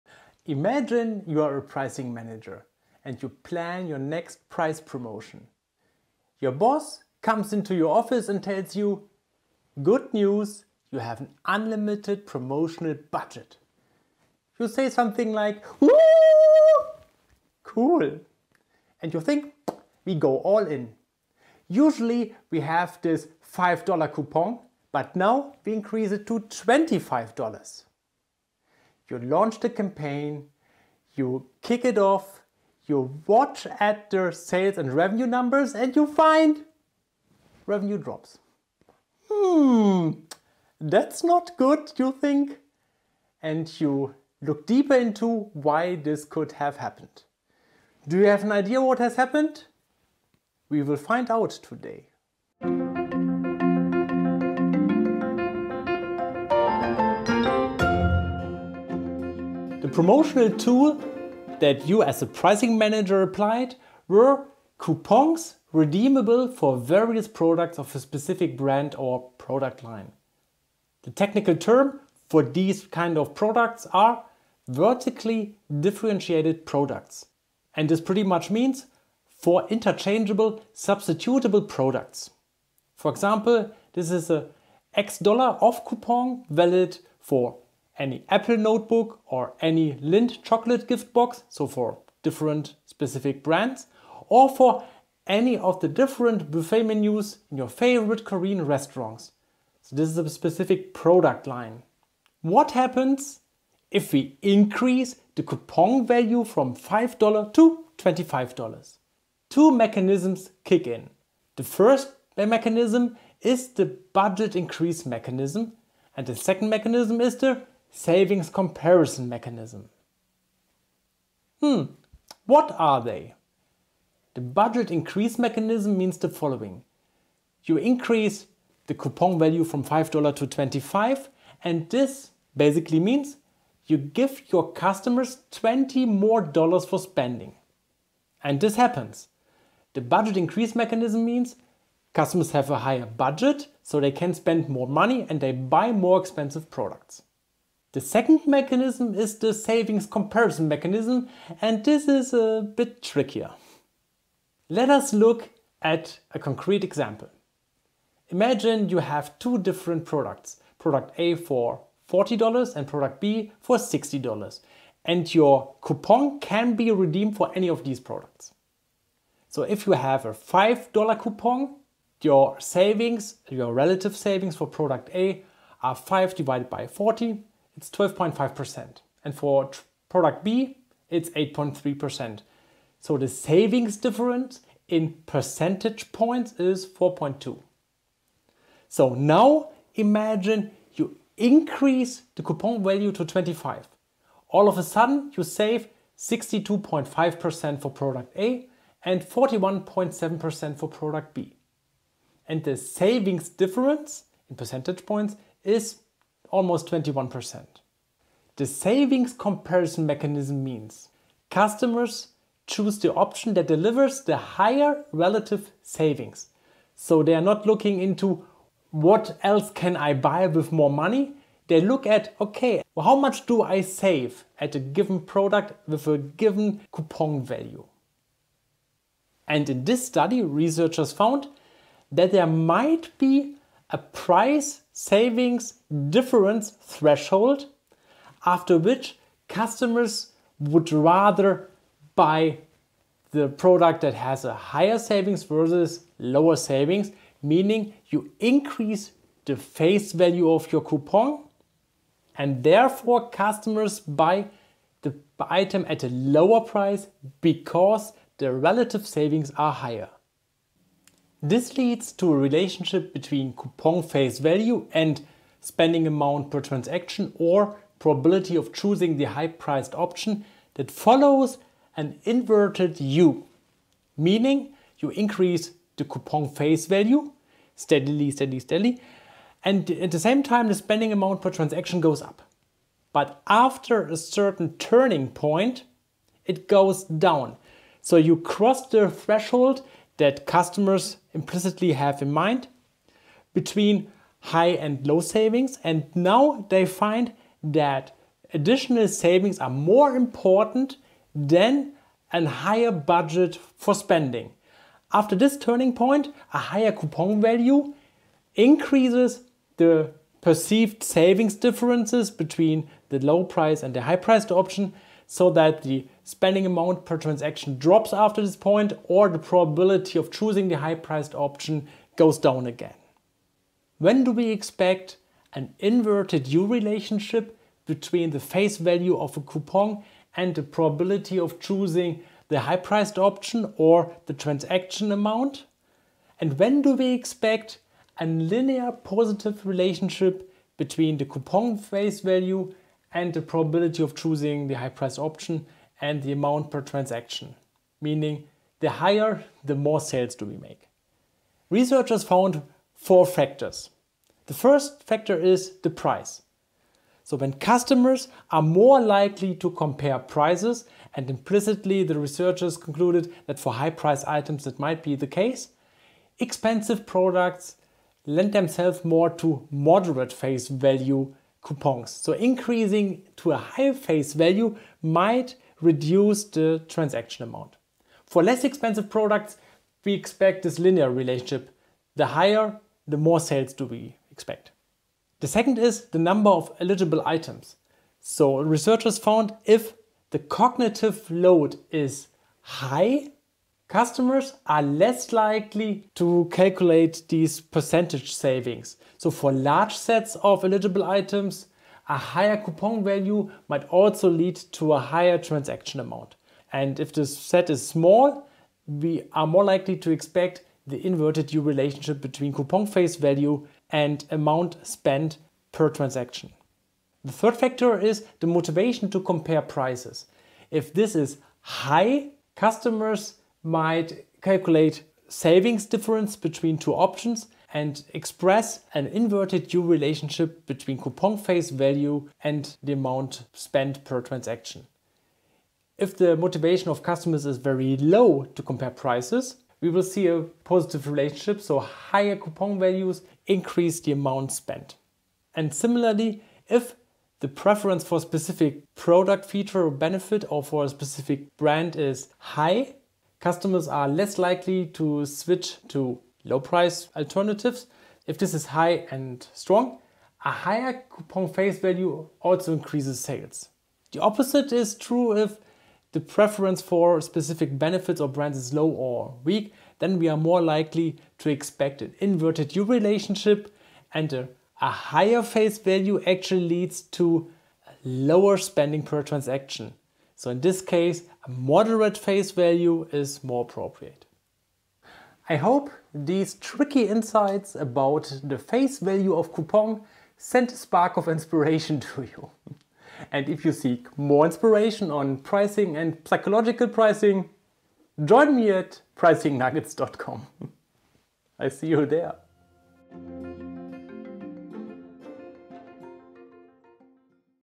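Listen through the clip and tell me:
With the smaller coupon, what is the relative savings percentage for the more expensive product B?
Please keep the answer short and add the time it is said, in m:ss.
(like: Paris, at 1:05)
8.3%, at 3:01.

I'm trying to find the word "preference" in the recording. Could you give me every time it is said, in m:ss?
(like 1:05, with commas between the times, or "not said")
7:27, 7:46.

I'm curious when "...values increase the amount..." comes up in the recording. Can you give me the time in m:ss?
7:22.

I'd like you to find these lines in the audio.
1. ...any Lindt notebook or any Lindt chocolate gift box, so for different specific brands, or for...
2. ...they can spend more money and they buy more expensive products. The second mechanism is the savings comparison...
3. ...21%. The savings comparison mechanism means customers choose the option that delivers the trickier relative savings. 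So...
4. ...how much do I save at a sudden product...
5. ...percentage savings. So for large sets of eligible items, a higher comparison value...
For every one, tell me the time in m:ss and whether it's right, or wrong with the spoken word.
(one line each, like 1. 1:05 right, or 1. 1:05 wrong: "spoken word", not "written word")
1. 1:27 wrong: "Apple", not "Lindt"
2. 2:23 right
3. 3:26 wrong: "higher", not "trickier"
4. 3:43 wrong: "given", not "sudden"
5. 6:37 wrong: "coupon", not "comparison".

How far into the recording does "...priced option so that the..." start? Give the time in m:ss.
5:14.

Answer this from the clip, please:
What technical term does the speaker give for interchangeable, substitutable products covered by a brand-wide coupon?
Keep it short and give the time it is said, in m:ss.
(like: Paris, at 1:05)
vertically differentiated products, at 1:14.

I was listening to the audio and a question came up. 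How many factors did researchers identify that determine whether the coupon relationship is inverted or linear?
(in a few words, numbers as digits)
4.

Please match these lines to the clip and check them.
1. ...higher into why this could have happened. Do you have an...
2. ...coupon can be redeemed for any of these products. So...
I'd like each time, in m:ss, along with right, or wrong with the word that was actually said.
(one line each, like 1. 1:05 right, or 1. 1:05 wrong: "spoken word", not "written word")
1. 0:44 wrong: "deeper", not "higher"
2. 2:45 right.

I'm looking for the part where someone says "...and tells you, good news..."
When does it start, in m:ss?
0:08.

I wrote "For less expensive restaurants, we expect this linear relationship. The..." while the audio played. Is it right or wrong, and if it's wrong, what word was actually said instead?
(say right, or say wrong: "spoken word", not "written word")
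wrong: "products", not "restaurants".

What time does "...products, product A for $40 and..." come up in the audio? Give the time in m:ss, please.
2:40.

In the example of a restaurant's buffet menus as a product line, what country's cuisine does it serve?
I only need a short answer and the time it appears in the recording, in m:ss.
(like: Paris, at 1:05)
Korean, at 1:38.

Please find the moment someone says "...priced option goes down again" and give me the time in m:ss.
5:20.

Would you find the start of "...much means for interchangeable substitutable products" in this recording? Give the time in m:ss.
1:18.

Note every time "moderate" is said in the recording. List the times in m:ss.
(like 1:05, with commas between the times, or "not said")
6:09, 8:01.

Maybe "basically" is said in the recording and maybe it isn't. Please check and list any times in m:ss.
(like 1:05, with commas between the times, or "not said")
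2:12.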